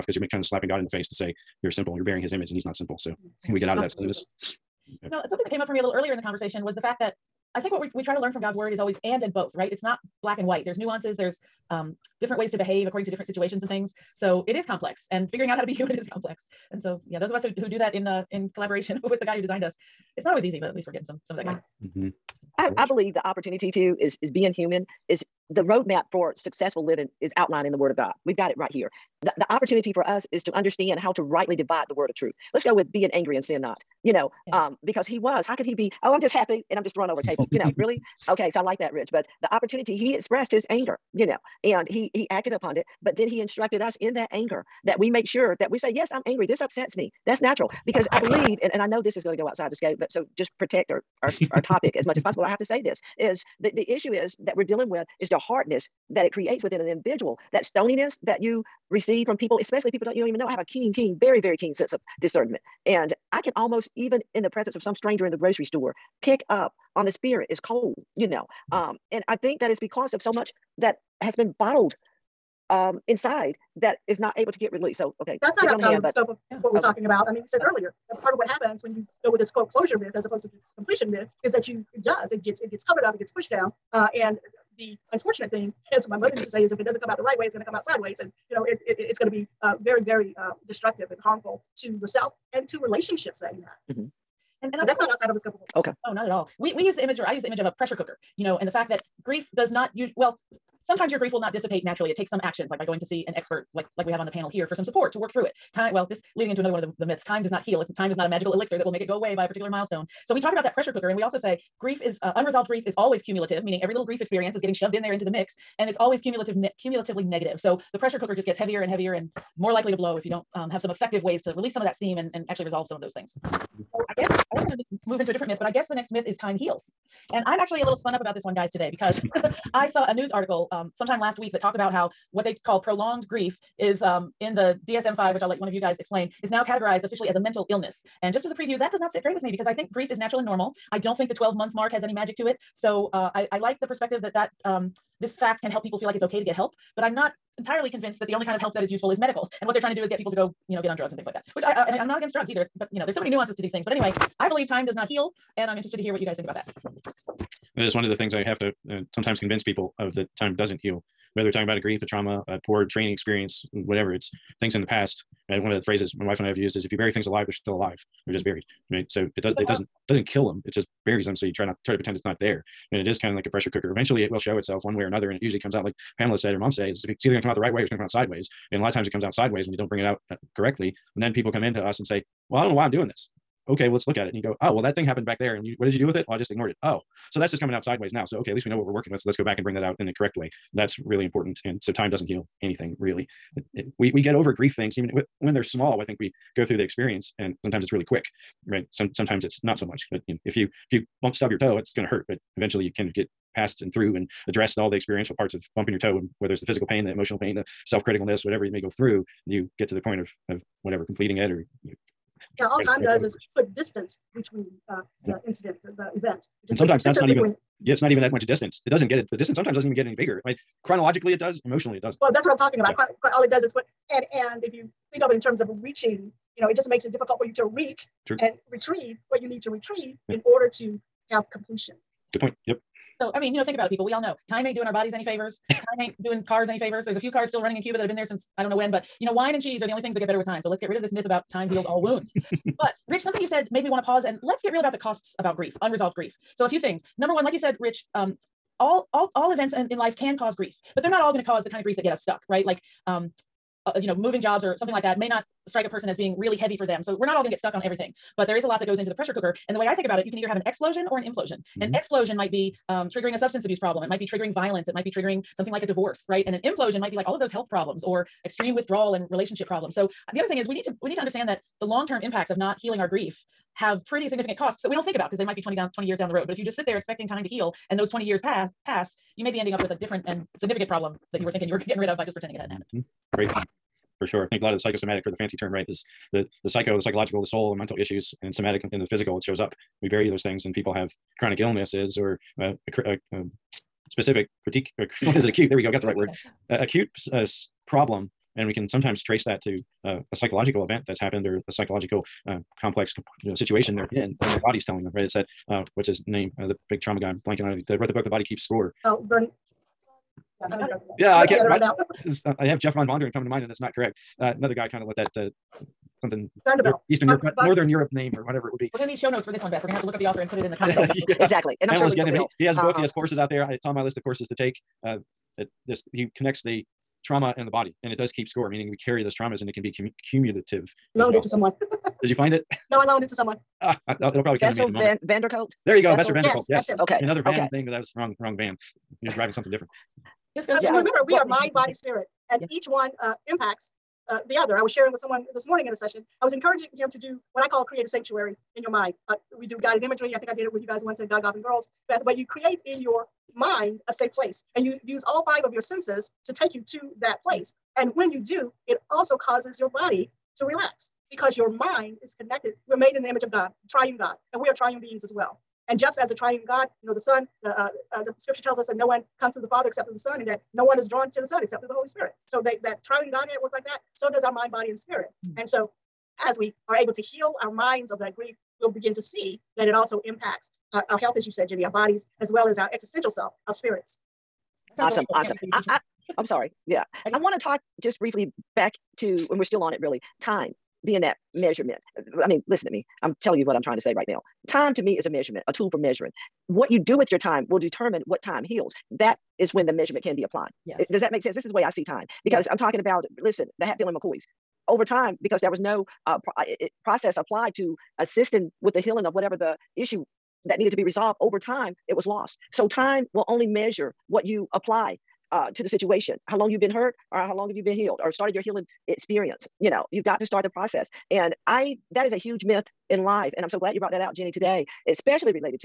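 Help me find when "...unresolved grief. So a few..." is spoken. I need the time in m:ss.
4:05.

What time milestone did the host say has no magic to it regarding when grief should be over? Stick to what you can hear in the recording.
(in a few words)
12 month mark.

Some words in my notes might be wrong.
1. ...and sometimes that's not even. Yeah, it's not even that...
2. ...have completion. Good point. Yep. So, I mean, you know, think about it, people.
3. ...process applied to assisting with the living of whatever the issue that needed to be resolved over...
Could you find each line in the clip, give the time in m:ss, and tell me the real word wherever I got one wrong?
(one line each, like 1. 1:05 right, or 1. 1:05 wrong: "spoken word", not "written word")
1. 3:36 right
2. 3:51 right
3. 6:47 wrong: "healing", not "living".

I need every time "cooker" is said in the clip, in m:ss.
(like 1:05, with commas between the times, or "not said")
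1:37, 1:50, 1:58, 2:53, 4:19.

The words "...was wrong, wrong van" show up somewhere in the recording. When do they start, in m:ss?
5:37.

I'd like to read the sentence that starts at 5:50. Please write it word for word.
I think I did it with you guys once at God, Goff, and Girls.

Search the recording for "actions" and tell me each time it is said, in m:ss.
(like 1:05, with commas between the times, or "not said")
1:42.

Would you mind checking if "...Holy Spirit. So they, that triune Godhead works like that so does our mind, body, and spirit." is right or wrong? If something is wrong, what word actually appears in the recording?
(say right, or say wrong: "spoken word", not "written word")
right.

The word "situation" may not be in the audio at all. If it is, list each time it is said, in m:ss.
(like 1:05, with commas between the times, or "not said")
0:13, 5:03, 6:55.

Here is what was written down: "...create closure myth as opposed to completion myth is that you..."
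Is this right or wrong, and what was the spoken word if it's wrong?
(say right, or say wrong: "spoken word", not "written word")
wrong: "quote", not "create".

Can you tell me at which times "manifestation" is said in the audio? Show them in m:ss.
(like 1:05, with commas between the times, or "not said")
not said.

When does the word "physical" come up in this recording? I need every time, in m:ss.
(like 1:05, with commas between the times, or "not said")
3:26, 4:49.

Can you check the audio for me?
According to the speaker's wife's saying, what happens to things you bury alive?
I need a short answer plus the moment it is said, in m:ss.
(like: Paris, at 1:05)
They're still alive, at 2:47.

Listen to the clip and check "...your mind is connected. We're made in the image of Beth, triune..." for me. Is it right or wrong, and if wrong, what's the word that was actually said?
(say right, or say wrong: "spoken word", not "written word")
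wrong: "God", not "Beth".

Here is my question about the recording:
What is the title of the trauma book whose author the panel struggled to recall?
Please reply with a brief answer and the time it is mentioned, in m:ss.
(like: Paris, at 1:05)
The Body Keeps Score, at 5:08.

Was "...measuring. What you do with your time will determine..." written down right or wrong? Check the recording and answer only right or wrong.
right.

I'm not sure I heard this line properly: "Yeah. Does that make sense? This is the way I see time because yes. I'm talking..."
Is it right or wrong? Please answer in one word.
right.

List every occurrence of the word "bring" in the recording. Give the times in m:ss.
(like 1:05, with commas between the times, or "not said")
2:59, 3:09.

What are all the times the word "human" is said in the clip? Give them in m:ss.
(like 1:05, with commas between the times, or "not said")
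0:15, 0:24.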